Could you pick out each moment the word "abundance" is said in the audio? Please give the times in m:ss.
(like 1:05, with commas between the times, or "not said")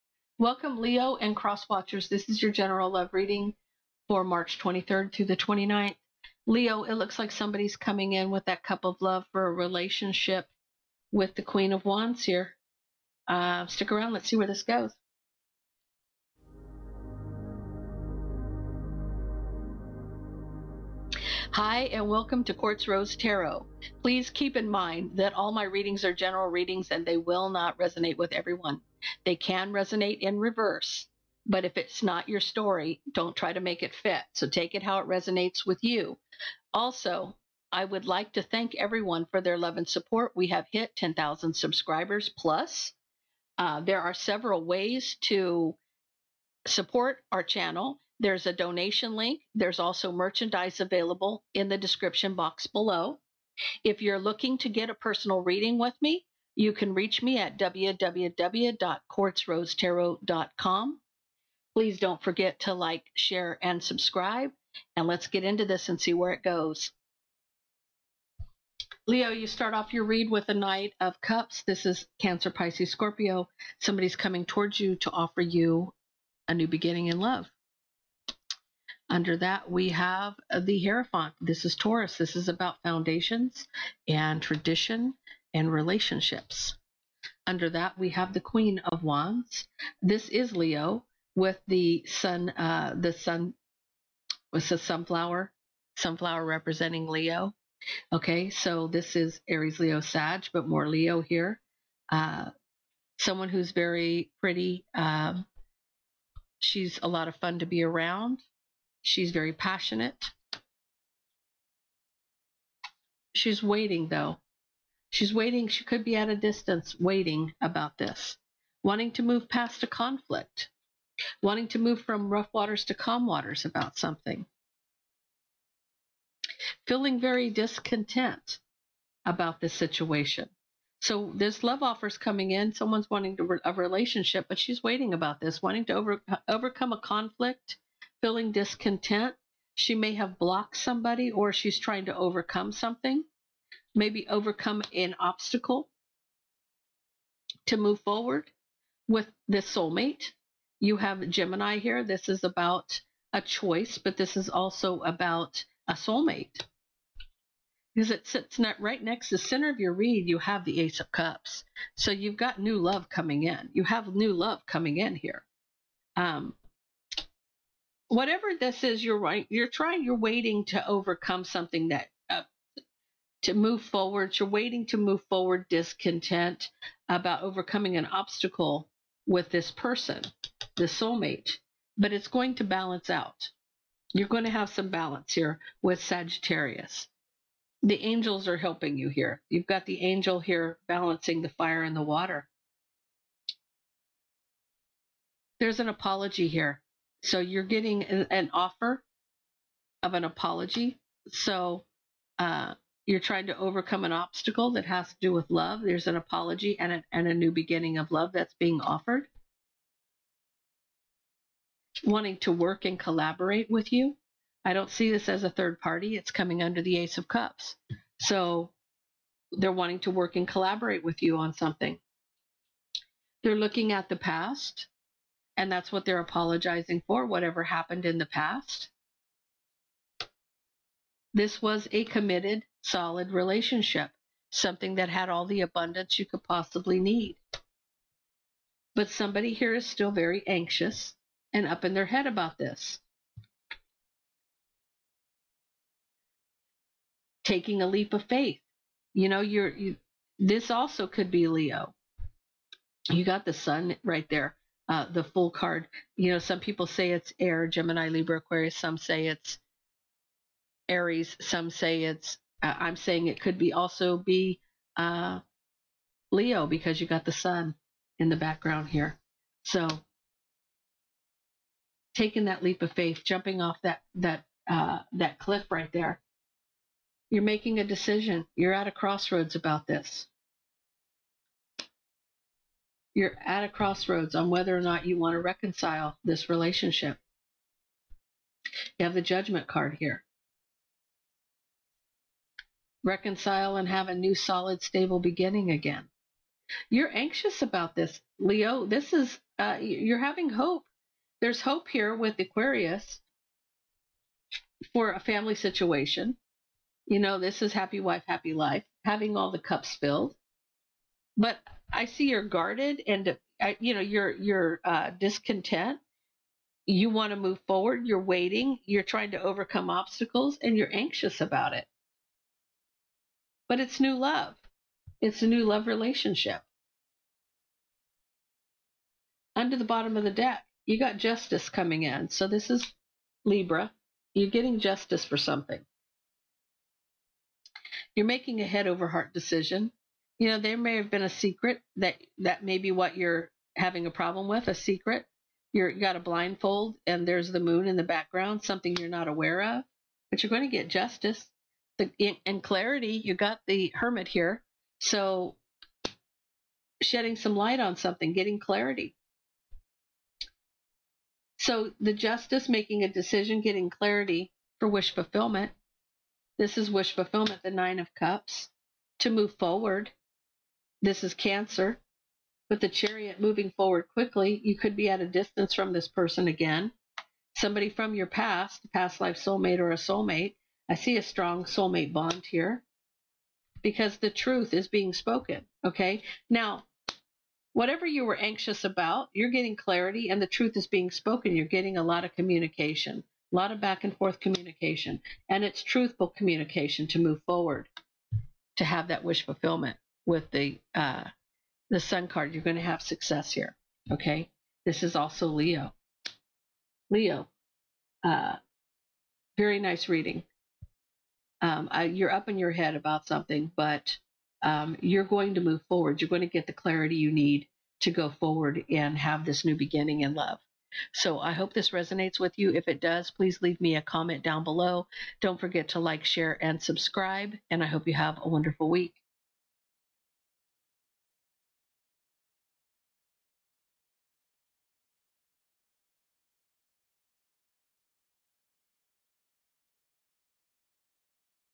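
3:55.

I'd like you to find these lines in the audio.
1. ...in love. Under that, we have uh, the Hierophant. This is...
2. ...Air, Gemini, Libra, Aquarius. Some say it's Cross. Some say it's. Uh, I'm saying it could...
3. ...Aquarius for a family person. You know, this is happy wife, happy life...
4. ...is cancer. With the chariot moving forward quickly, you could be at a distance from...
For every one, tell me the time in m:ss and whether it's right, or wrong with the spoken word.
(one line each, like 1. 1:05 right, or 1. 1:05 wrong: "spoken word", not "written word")
1. 1:17 right
2. 4:17 wrong: "Aries", not "Cross"
3. 5:02 wrong: "situation", not "person"
4. 6:11 right.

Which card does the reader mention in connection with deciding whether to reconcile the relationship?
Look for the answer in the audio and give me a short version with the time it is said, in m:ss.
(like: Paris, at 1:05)
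Judgment, at 4:49.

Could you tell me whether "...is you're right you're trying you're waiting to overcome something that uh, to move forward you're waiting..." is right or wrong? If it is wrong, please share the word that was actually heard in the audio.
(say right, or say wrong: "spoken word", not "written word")
right.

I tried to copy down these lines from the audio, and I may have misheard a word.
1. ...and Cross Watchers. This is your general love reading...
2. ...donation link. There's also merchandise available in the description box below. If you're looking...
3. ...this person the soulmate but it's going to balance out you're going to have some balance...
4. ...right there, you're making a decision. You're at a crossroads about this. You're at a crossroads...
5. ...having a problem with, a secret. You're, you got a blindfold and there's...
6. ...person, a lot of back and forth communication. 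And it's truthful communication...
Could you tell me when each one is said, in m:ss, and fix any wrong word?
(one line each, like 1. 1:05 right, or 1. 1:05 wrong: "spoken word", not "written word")
1. 0:01 right
2. 0:48 right
3. 2:59 right
4. 4:35 right
5. 5:43 right
6. 6:32 wrong: "communication", not "person".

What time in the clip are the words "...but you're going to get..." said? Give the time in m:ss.
5:50.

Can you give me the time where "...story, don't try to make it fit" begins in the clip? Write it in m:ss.
0:32.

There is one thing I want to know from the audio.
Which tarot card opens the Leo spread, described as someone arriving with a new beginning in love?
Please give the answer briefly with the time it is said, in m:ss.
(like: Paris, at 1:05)
Knight of Cups, at 1:10.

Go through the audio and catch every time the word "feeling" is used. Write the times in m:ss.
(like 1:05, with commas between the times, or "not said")
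2:06, 2:18.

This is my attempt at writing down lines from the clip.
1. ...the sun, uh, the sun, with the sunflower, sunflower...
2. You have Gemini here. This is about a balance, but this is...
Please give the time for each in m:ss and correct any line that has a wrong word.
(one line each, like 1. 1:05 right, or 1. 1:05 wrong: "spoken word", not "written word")
1. 1:31 right
2. 2:30 wrong: "choice", not "balance".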